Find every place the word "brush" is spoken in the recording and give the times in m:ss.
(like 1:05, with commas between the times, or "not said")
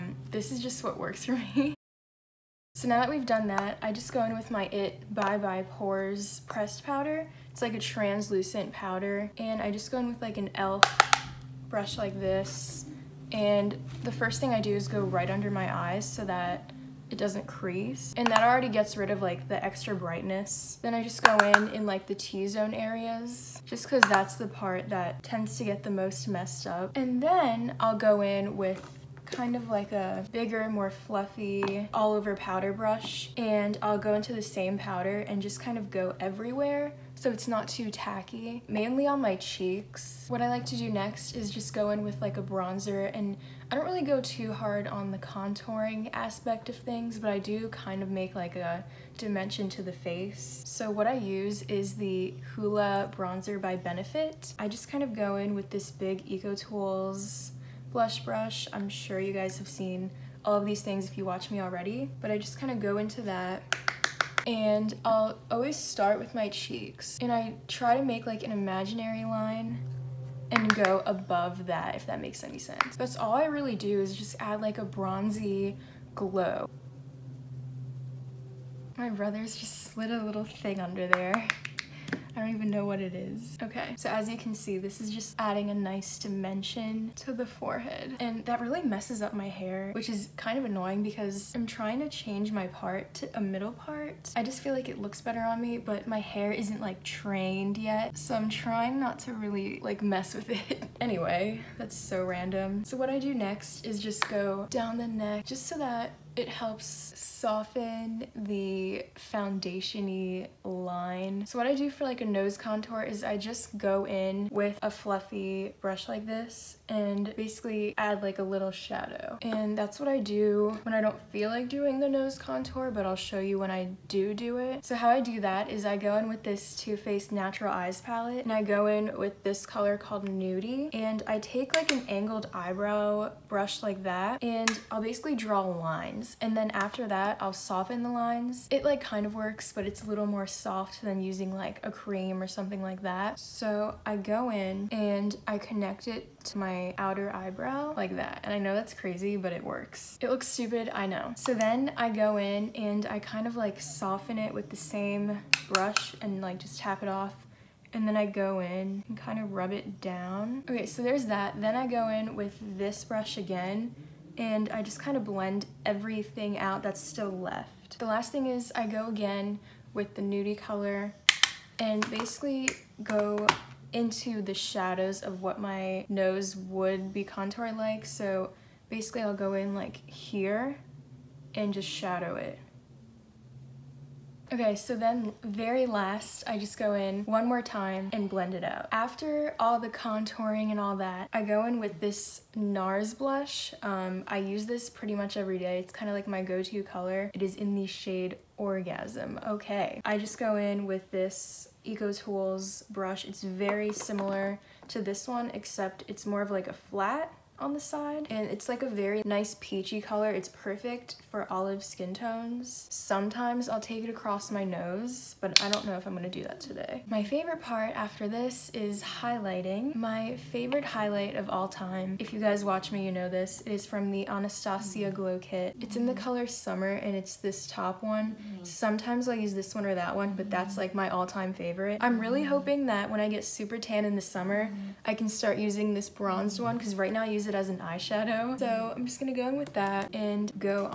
0:11, 0:32, 0:58, 1:55, 2:13, 2:35, 2:43, 3:22.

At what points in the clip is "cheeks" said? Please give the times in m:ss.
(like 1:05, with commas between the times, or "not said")
0:39, 1:06.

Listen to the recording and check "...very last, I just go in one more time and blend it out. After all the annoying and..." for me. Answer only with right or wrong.
wrong.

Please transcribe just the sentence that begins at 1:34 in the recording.
I just feel like it looks better on me, but my hair isn't like trained yet.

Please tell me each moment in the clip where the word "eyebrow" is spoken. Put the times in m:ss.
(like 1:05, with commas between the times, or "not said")
2:12, 2:27.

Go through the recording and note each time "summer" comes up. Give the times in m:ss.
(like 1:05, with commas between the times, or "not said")
3:46, 3:54.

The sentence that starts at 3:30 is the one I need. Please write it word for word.
It's perfect for olive skin tones.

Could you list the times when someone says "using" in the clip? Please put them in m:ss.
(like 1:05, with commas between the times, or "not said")
2:21, 3:55.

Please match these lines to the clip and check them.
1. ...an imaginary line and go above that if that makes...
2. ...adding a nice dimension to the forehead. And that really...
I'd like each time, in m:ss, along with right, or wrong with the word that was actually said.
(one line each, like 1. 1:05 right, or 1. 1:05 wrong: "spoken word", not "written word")
1. 1:08 right
2. 1:25 right.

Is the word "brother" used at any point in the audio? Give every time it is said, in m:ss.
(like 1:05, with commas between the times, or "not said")
1:19.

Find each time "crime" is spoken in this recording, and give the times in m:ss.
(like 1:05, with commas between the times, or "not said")
not said.